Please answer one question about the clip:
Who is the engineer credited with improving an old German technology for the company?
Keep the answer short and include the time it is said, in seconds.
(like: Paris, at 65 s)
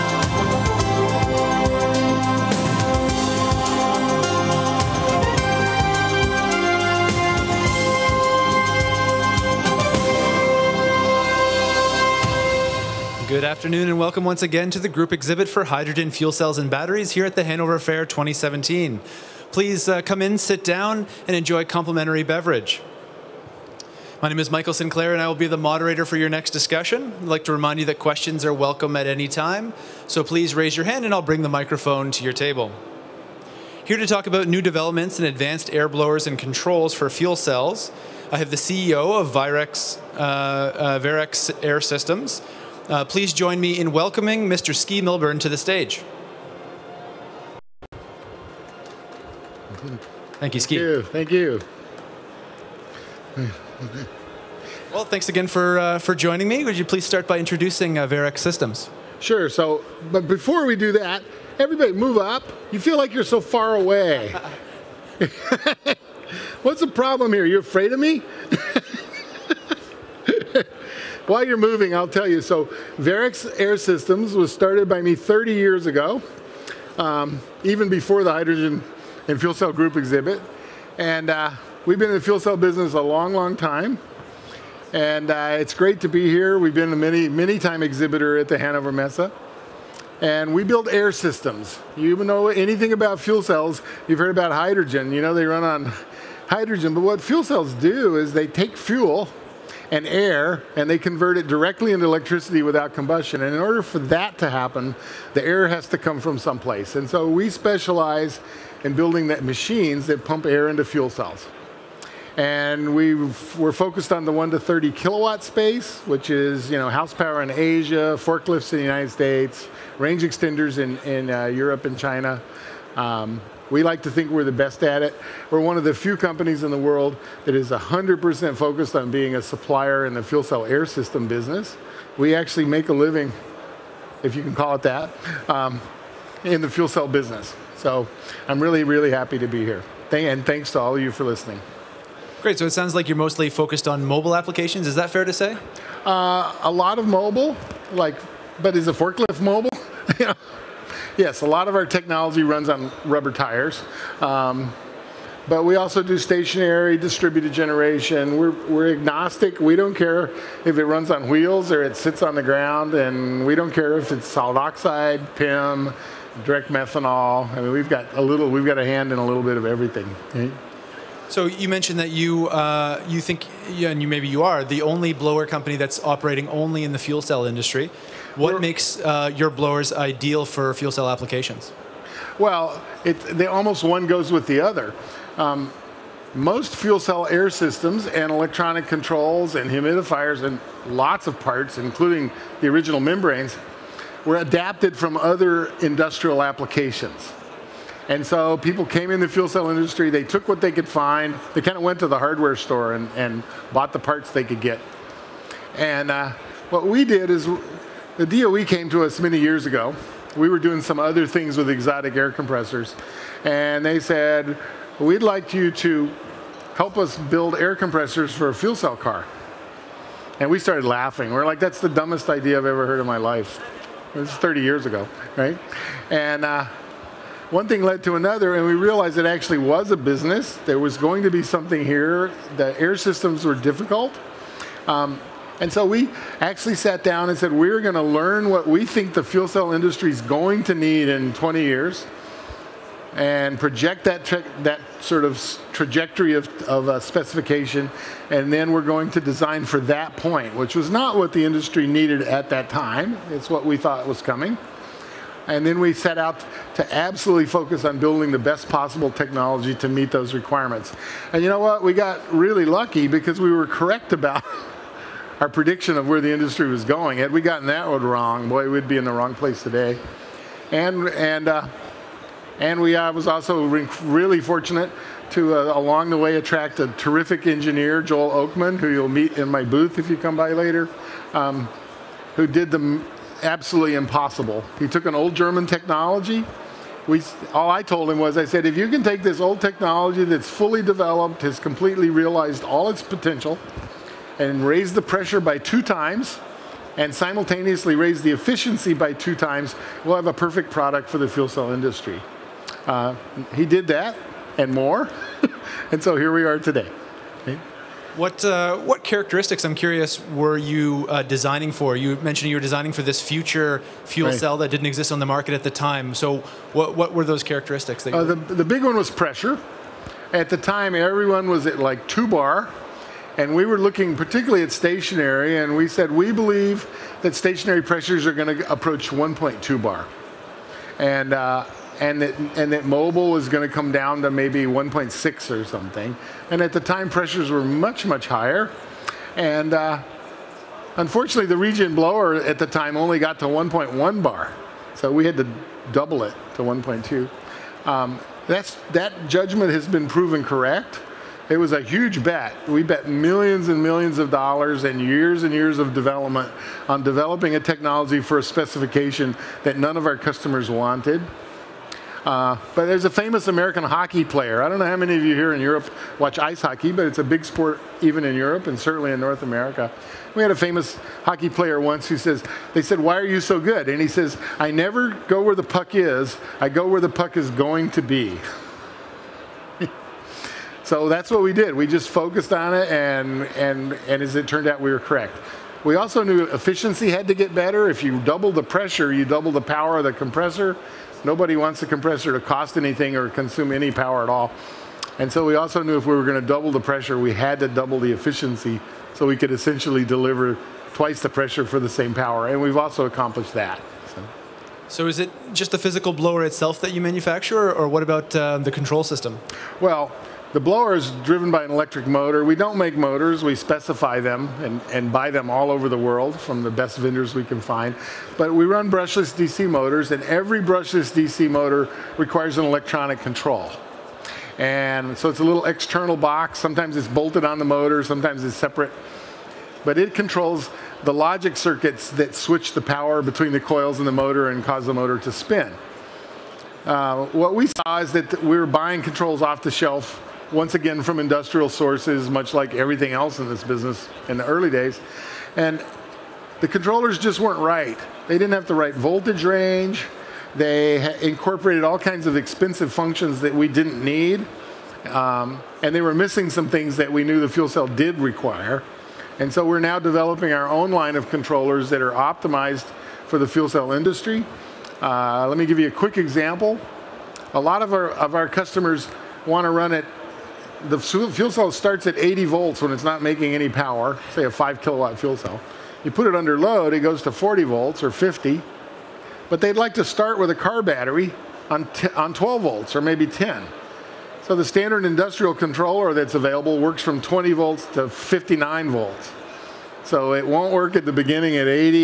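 Joel Oakman, at 278 s.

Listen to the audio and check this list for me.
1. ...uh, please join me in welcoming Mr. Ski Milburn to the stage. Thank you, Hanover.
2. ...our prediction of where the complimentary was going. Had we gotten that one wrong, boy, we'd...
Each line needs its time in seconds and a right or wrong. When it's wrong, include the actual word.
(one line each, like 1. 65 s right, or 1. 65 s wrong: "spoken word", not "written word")
1. 42 s wrong: "Ski", not "Hanover"
2. 265 s wrong: "industry", not "complimentary".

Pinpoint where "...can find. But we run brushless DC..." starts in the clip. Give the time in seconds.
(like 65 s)
417 s.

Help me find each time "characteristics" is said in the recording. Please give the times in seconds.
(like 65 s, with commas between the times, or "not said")
309 s, 317 s.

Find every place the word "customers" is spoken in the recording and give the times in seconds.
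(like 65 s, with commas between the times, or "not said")
360 s, 468 s.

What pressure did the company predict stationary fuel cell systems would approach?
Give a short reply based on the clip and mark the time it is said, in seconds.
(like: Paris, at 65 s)
1.2 bar, at 329 s.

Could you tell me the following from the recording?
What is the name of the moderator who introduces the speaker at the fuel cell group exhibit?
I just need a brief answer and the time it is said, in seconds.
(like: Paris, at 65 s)
Michael Sinclair, at 24 s.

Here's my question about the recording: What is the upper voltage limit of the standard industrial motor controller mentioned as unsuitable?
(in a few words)
59 volts.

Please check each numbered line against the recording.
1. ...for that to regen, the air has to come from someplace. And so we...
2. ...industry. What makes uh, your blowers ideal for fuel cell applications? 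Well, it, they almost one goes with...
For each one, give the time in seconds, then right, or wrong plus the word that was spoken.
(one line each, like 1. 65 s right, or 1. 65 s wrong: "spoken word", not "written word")
1. 103 s wrong: "happen", not "regen"
2. 177 s right.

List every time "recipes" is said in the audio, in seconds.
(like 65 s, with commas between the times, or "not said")
not said.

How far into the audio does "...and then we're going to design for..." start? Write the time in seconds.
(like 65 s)
248 s.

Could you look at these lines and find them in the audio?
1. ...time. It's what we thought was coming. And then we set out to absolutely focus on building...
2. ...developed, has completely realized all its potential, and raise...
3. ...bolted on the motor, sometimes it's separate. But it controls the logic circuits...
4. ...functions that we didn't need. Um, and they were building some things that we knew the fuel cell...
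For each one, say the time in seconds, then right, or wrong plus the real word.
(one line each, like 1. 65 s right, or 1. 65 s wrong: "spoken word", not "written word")
1. 252 s right
2. 290 s right
3. 427 s right
4. 452 s wrong: "missing", not "building".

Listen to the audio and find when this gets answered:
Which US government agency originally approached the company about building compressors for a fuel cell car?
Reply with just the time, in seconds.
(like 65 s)
208 s.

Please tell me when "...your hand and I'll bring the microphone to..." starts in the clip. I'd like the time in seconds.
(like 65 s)
30 s.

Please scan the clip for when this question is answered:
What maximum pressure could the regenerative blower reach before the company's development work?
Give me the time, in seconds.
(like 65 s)
343 s.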